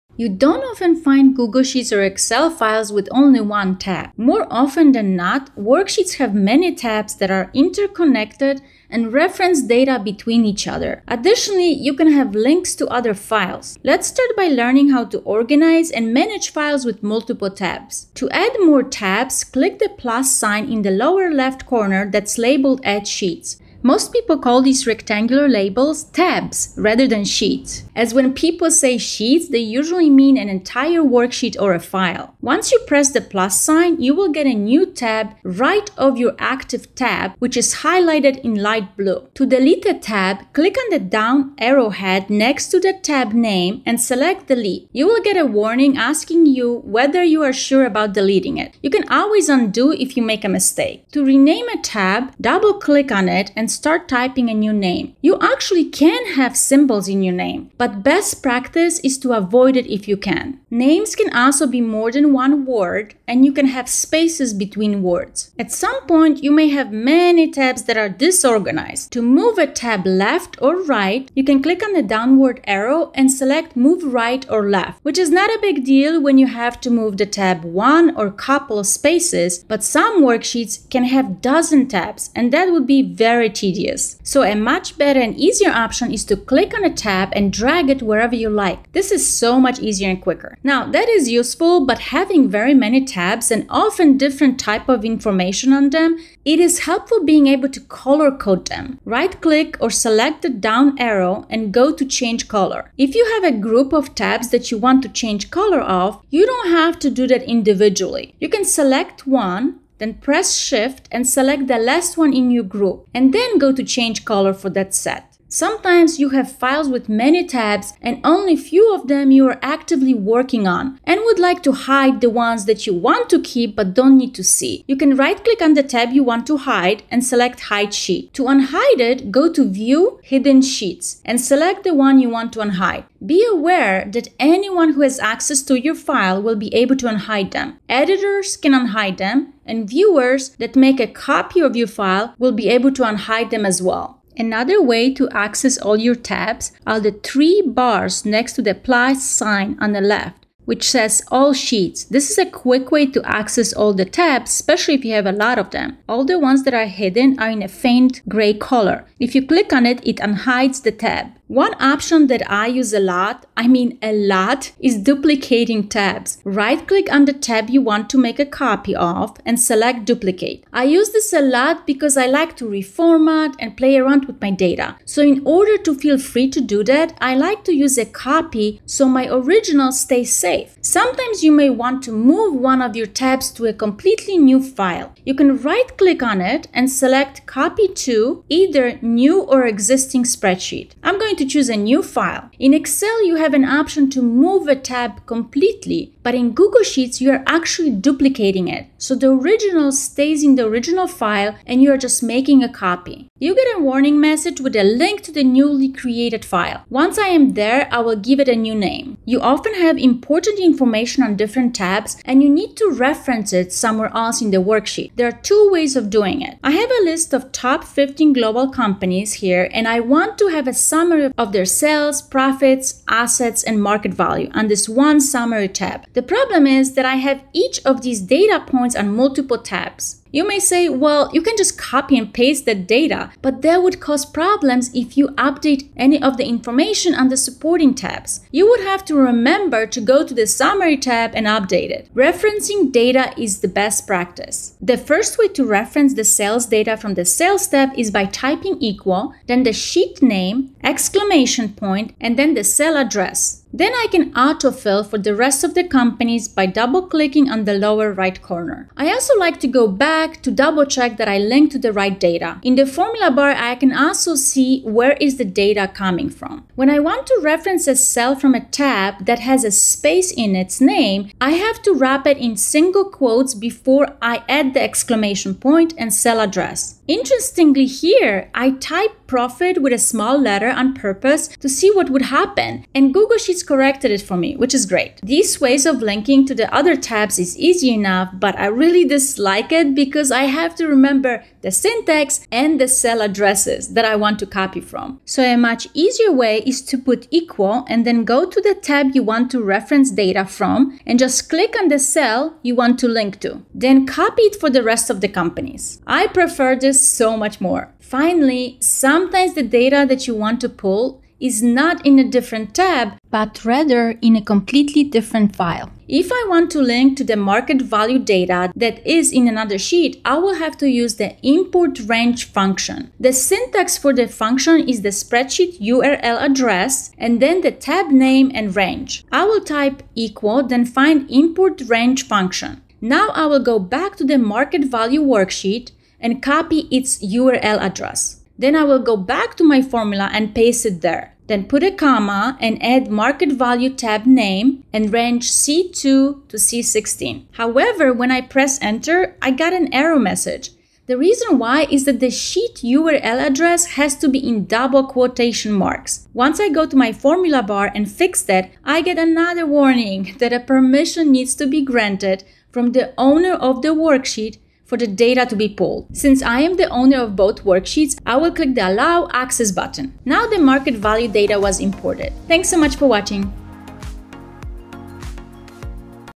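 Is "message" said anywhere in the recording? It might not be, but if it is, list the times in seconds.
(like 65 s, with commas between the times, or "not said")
204 s, 350 s.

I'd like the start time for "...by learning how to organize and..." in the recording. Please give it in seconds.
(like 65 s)
14 s.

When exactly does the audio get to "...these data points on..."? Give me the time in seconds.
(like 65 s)
228 s.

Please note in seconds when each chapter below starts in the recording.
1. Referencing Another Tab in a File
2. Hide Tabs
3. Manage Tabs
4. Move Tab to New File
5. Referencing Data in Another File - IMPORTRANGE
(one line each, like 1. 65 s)
1. 210 s
2. 116 s
3. 19 s
4. 182 s
5. 308 s.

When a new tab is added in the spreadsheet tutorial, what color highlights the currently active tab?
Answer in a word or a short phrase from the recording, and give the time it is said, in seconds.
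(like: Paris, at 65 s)
Light blue, at 38 s.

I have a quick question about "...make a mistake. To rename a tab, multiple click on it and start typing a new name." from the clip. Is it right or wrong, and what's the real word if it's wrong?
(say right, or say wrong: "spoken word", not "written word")
wrong: "double", not "multiple".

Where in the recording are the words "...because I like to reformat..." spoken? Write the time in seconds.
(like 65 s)
171 s.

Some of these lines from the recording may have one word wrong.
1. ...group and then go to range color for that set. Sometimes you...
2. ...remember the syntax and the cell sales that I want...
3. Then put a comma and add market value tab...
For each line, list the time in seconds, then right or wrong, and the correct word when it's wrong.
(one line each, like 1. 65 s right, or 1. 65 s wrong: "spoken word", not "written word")
1. 112 s wrong: "change", not "range"
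2. 290 s wrong: "addresses", not "sales"
3. 341 s right.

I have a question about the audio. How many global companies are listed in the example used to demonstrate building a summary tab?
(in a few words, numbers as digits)
15.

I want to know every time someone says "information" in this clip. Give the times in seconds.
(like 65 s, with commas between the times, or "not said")
95 s, 210 s, 236 s.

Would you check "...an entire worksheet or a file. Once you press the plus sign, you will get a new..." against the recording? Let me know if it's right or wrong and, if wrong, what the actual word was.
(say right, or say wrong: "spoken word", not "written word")
right.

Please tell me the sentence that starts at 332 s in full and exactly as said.
Now I will go back to the market value worksheet and copy its URL address.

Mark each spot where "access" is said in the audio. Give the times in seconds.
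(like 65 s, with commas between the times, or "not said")
135 s, 145 s, 153 s, 369 s.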